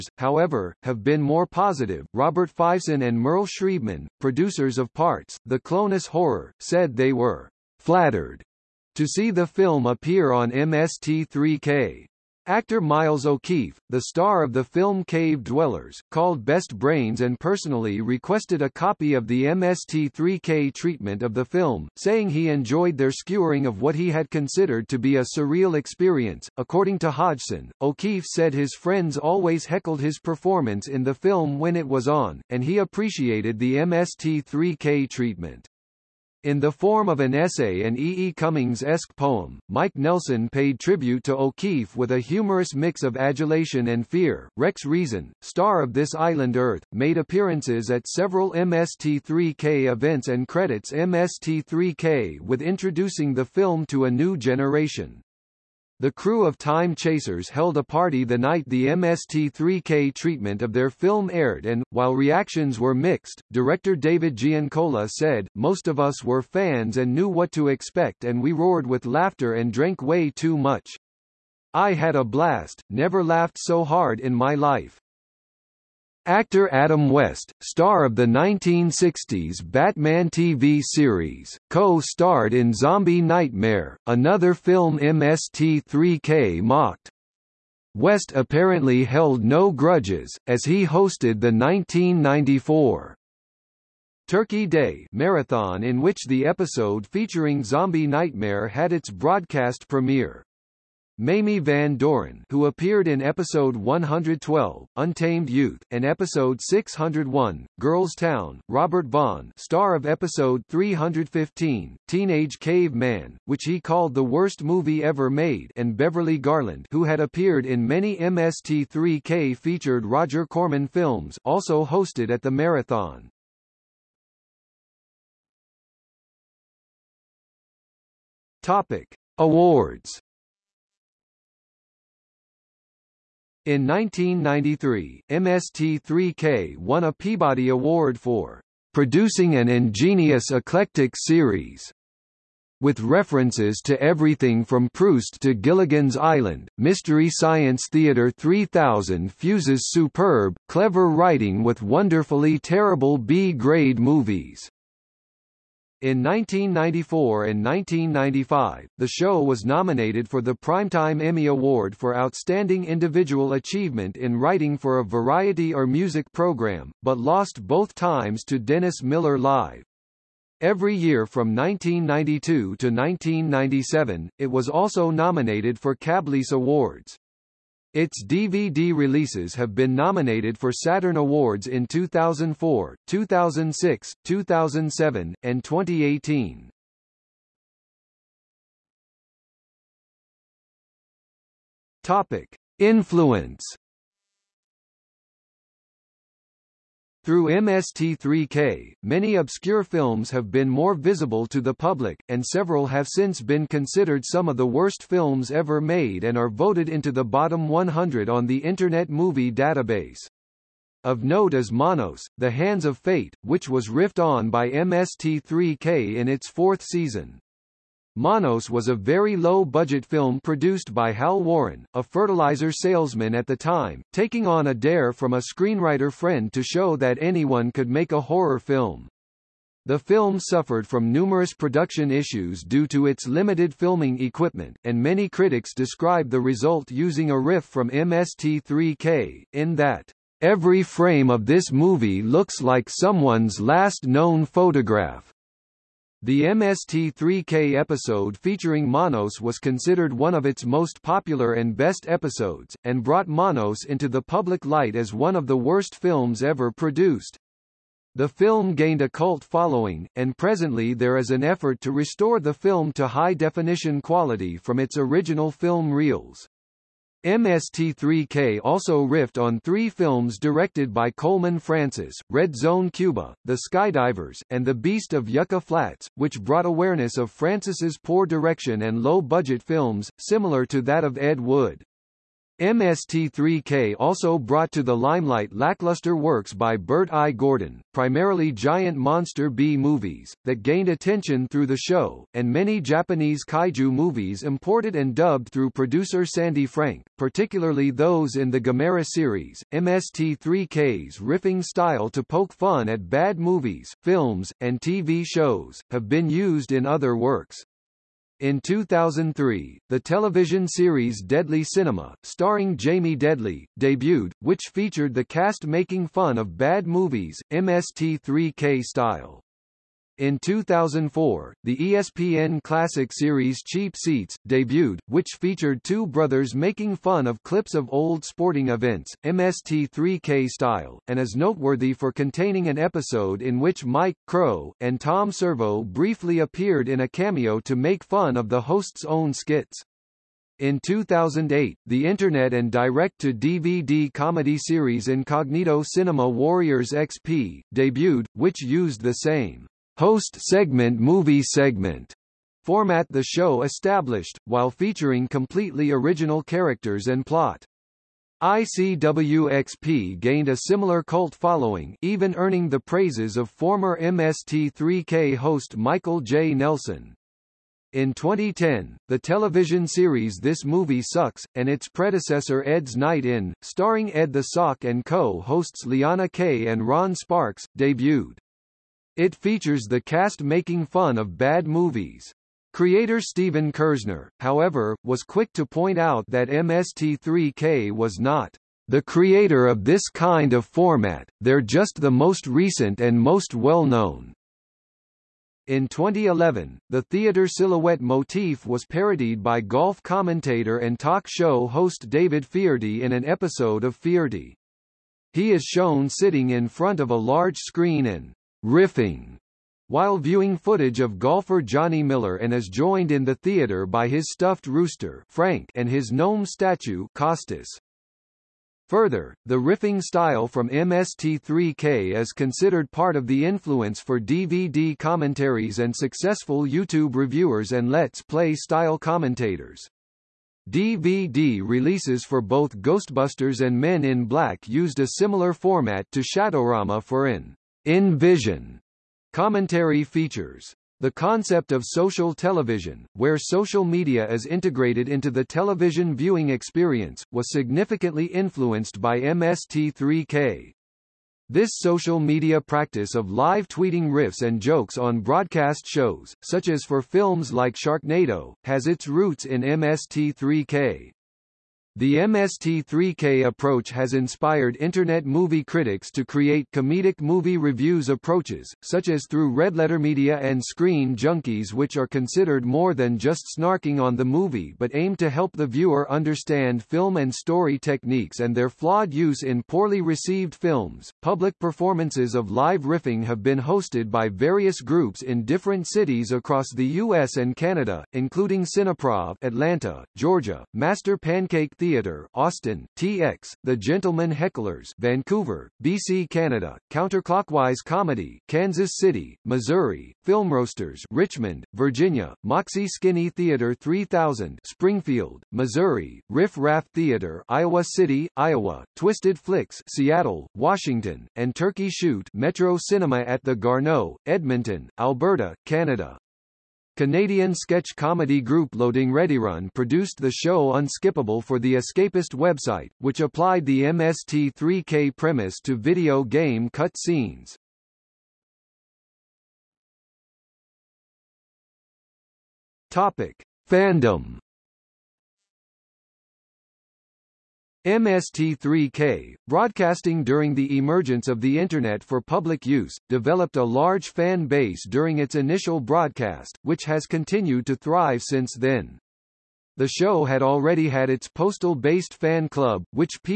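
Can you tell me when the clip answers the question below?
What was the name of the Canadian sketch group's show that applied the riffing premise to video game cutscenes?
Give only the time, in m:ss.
8:40.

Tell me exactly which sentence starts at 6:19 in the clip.
It features the cast making fun of bad movies.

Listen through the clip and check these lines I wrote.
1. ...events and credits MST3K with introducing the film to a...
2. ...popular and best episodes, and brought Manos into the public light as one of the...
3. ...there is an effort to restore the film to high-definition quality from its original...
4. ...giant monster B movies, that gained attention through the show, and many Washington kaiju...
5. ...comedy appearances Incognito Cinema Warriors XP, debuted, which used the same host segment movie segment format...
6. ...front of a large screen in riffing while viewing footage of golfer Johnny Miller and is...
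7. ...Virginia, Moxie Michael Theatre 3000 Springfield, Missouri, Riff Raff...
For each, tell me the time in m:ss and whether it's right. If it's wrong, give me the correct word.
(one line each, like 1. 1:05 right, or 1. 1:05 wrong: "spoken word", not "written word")
1. 0:49 right
2. 4:11 right
3. 4:20 right
4. 4:48 wrong: "Japanese", not "Washington"
5. 5:44 wrong: "series", not "appearances"
6. 6:46 right
7. 8:21 wrong: "Skinny", not "Michael".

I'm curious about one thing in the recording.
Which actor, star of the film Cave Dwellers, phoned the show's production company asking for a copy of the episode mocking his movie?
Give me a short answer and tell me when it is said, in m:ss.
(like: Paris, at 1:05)
Miles O'Keefe, at 0:12.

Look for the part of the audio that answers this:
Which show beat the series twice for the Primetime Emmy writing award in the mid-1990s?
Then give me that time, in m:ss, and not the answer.
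2:48.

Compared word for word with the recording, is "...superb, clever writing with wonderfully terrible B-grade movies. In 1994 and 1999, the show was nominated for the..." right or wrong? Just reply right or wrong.
wrong.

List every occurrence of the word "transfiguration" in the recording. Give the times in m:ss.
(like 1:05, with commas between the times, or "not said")
not said.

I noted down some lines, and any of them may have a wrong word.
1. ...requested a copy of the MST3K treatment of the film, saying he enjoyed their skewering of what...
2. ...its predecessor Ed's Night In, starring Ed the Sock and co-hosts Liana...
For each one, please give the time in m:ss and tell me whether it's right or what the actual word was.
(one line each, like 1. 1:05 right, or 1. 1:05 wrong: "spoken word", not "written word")
1. 0:17 right
2. 6:11 right.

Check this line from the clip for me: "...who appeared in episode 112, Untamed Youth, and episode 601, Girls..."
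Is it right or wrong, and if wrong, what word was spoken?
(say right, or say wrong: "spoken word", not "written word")
right.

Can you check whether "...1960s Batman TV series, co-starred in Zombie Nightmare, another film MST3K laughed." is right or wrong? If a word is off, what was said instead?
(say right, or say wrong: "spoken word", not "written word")
wrong: "mocked", not "laughed".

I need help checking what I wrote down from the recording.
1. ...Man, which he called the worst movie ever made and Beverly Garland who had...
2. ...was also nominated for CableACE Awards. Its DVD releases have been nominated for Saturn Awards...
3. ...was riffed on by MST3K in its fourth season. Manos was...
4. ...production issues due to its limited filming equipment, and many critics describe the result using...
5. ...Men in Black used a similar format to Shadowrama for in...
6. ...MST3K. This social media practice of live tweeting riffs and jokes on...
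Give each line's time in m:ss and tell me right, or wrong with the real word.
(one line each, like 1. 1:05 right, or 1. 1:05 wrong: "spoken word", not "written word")
1. 1:52 right
2. 2:54 right
3. 3:33 right
4. 3:51 right
5. 7:13 right
6. 7:29 right.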